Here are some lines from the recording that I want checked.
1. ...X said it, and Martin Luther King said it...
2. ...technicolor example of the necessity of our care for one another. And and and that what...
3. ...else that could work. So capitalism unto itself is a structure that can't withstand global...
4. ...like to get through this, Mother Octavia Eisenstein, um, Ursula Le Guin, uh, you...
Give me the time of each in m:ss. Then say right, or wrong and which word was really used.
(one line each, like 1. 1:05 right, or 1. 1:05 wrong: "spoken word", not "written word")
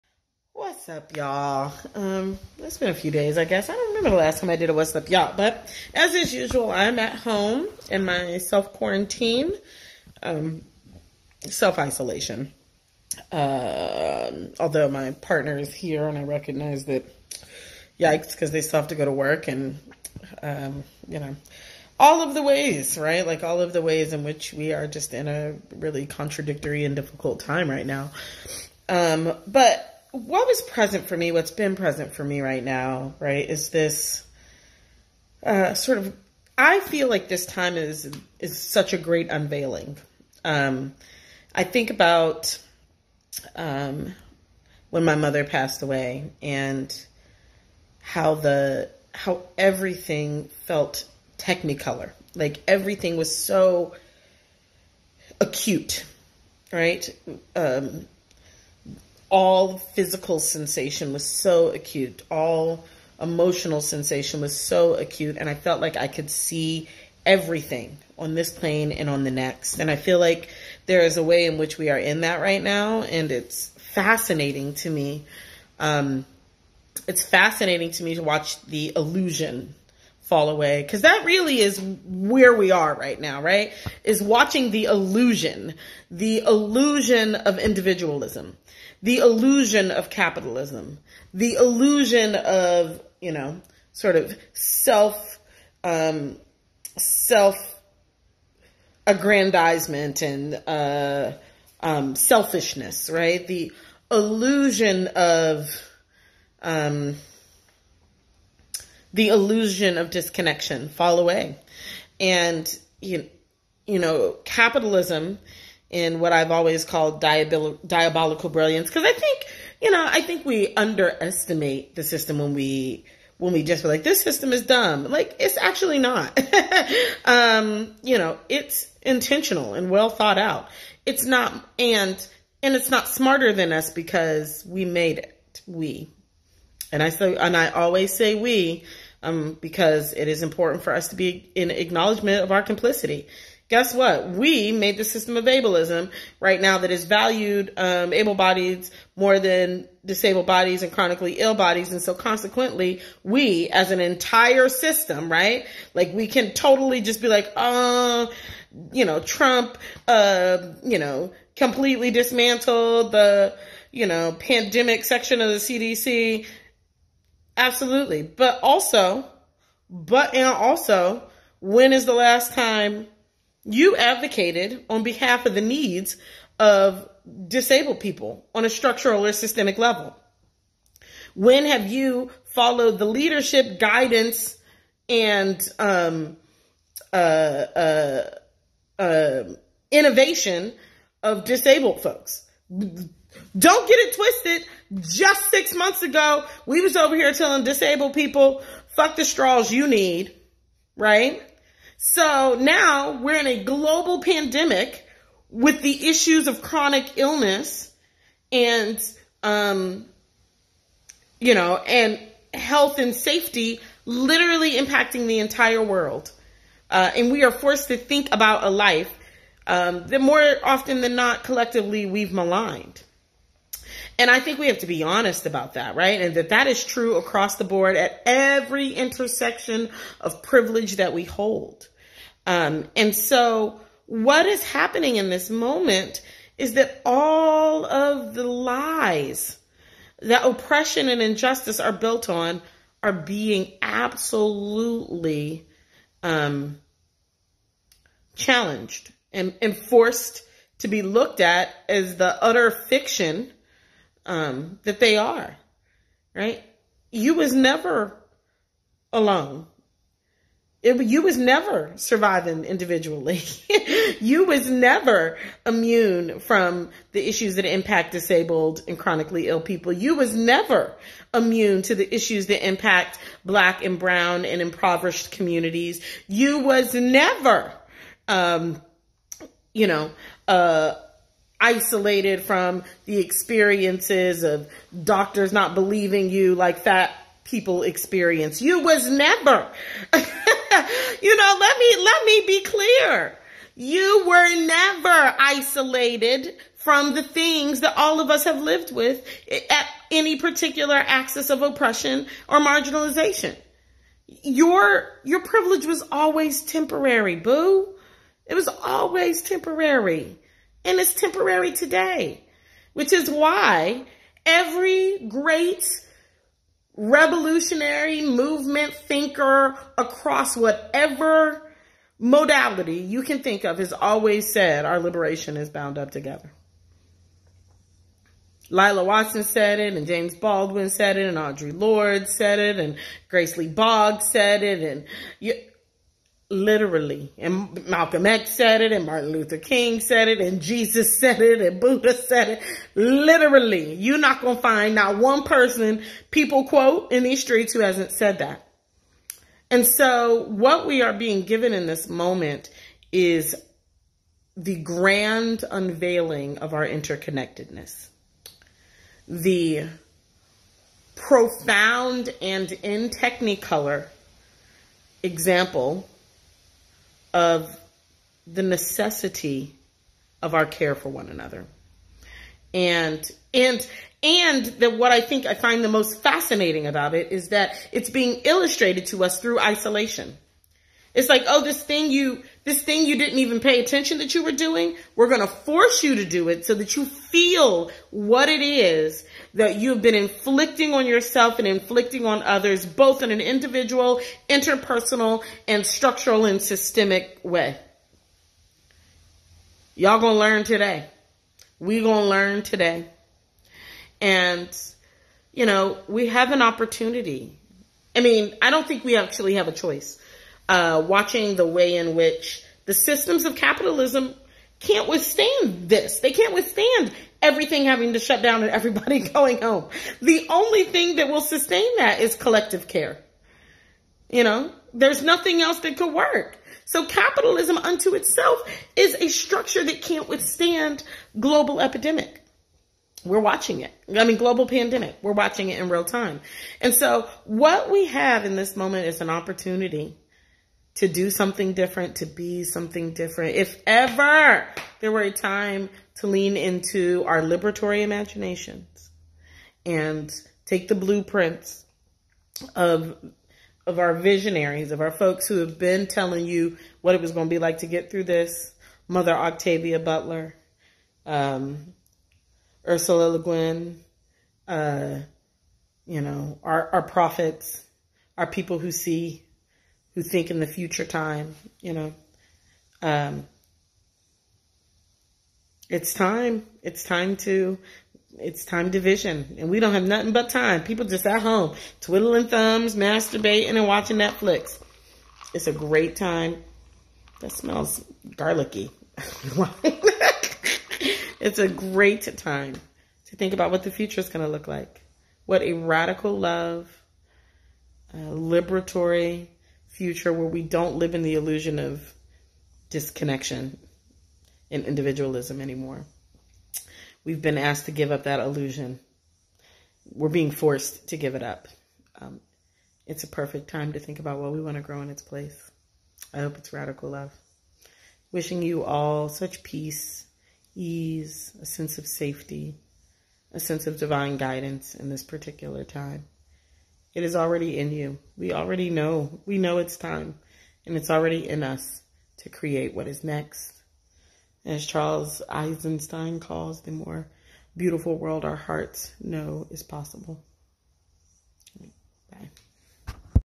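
1. 5:38 right
2. 6:03 right
3. 7:05 right
4. 7:37 wrong: "Butler", not "Eisenstein".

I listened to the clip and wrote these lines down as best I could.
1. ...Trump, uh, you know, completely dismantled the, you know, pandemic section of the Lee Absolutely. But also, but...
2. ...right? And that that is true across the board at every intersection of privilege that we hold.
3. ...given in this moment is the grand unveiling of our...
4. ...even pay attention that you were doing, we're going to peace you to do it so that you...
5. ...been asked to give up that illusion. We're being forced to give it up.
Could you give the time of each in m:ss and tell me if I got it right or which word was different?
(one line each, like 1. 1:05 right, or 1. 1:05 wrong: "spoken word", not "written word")
1. 2:39 wrong: "CDC", not "Lee"
2. 3:45 right
3. 5:51 right
4. 6:23 wrong: "force", not "peace"
5. 8:27 right.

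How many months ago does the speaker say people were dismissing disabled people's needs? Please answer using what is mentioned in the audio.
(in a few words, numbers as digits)
6.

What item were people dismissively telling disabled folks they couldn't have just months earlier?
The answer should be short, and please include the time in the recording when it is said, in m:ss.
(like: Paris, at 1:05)
Straws, at 3:19.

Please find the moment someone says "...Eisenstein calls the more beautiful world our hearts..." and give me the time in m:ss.
8:55.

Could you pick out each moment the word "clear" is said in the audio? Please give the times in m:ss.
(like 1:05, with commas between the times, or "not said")
4:52.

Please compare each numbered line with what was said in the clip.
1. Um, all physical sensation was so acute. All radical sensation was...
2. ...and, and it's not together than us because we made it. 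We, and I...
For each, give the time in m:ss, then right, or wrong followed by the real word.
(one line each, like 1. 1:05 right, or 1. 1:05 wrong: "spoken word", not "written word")
1. 0:57 wrong: "emotional", not "radical"
2. 2:11 wrong: "smarter", not "together".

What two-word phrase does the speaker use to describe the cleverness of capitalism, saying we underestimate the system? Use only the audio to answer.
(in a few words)
Diabolical brilliance.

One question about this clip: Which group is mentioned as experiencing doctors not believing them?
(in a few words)
Fat people.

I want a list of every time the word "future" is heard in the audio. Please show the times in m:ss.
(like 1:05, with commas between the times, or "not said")
7:50, 8:13, 8:19.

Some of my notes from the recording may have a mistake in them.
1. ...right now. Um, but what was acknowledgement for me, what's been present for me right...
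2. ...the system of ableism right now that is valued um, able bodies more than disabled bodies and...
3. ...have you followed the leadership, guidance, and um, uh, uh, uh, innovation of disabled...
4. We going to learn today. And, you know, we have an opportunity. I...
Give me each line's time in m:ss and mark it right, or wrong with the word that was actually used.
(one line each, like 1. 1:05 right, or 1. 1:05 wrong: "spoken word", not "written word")
1. 0:27 wrong: "present", not "acknowledgement"
2. 2:24 right
3. 3:01 right
4. 6:41 right.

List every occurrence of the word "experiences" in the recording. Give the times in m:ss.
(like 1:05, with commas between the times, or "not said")
4:43, 4:47.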